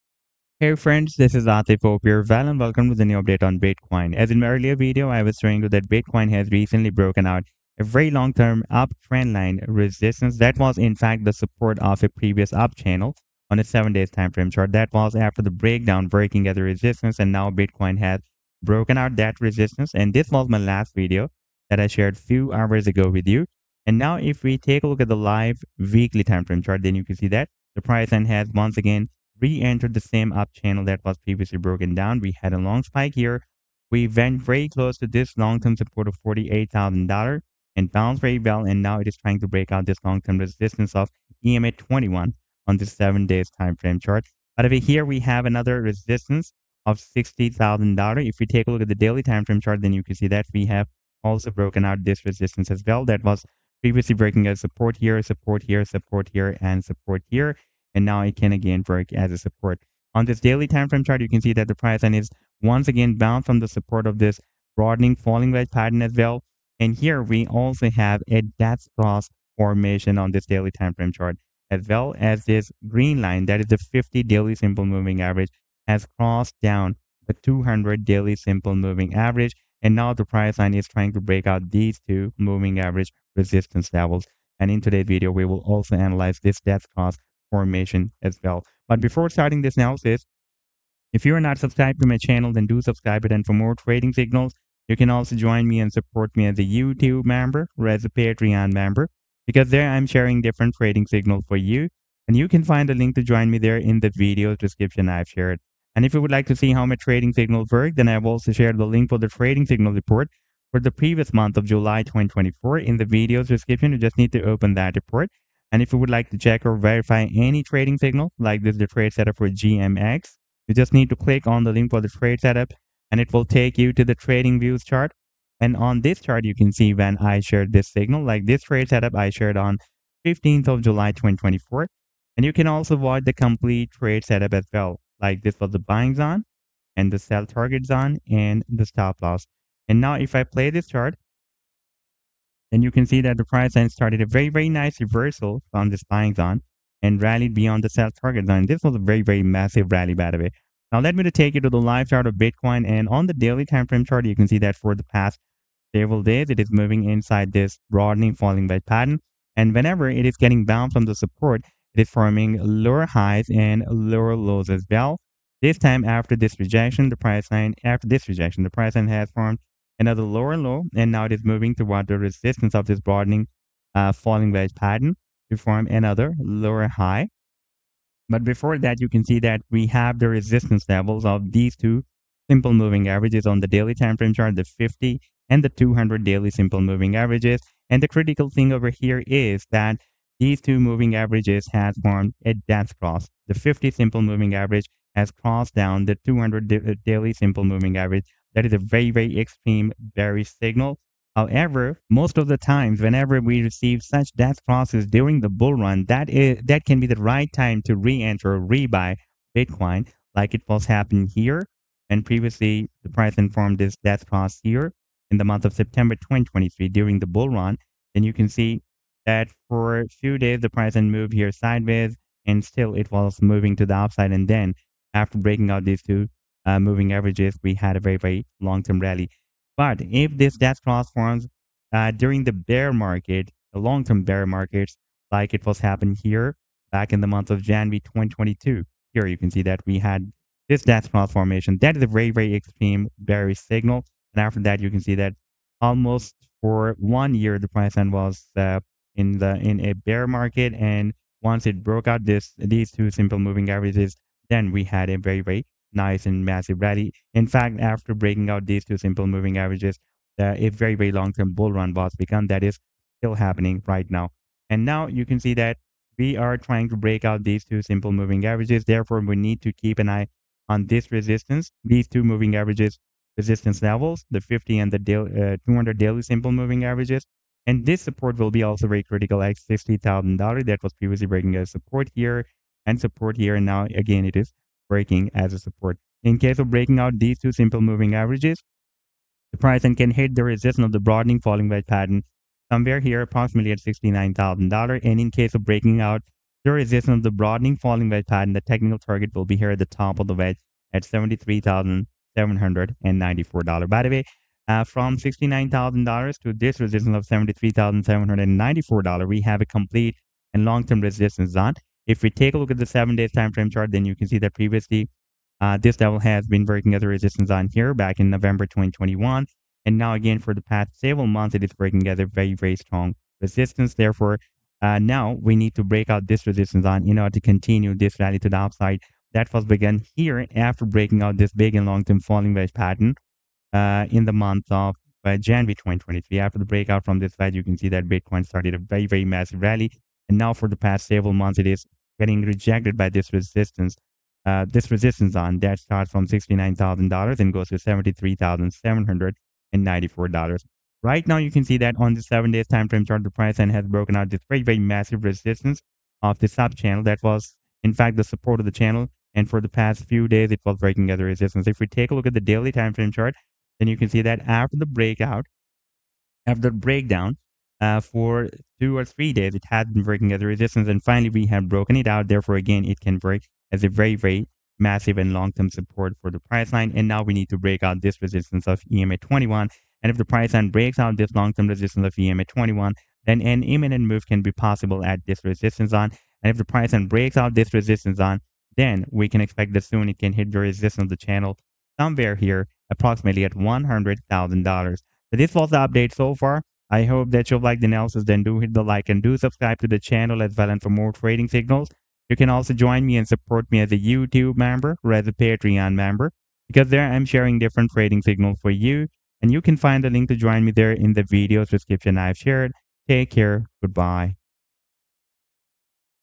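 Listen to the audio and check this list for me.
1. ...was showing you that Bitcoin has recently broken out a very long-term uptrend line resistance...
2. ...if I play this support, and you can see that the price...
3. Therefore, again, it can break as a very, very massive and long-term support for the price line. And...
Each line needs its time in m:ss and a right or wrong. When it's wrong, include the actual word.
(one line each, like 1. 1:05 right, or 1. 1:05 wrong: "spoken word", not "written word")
1. 0:05 right
2. 2:20 wrong: "chart", not "support"
3. 6:12 right.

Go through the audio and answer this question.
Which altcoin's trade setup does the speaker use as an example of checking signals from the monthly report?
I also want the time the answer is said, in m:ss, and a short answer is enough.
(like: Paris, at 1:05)
GMX, at 1:59.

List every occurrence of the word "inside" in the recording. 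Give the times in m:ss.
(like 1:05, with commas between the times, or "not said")
2:37.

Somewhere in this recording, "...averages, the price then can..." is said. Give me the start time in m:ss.
4:48.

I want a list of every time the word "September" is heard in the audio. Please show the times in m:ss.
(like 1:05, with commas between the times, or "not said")
3:35.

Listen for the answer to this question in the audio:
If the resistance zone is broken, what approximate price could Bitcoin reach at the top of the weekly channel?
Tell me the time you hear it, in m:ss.
6:33.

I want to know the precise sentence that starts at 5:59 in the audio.
And for the past few days, it was breaking other resistance.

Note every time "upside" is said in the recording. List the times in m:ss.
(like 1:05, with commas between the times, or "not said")
3:43, 5:28.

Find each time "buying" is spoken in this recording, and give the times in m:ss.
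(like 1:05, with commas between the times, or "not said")
2:15, 2:26.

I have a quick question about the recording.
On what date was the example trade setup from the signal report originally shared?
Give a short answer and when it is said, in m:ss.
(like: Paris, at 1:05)
15th of July 2024, at 2:10.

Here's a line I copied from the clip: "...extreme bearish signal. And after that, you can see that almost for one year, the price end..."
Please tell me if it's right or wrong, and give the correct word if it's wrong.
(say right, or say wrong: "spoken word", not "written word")
right.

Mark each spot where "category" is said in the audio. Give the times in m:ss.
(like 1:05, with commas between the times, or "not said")
not said.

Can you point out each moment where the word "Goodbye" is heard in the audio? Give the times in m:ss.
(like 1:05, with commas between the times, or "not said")
6:53.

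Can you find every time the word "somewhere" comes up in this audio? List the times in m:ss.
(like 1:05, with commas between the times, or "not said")
4:52, 6:31.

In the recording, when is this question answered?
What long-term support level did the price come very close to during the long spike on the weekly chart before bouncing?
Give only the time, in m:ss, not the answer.
0:36.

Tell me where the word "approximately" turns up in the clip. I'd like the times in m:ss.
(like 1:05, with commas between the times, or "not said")
4:53, 6:32.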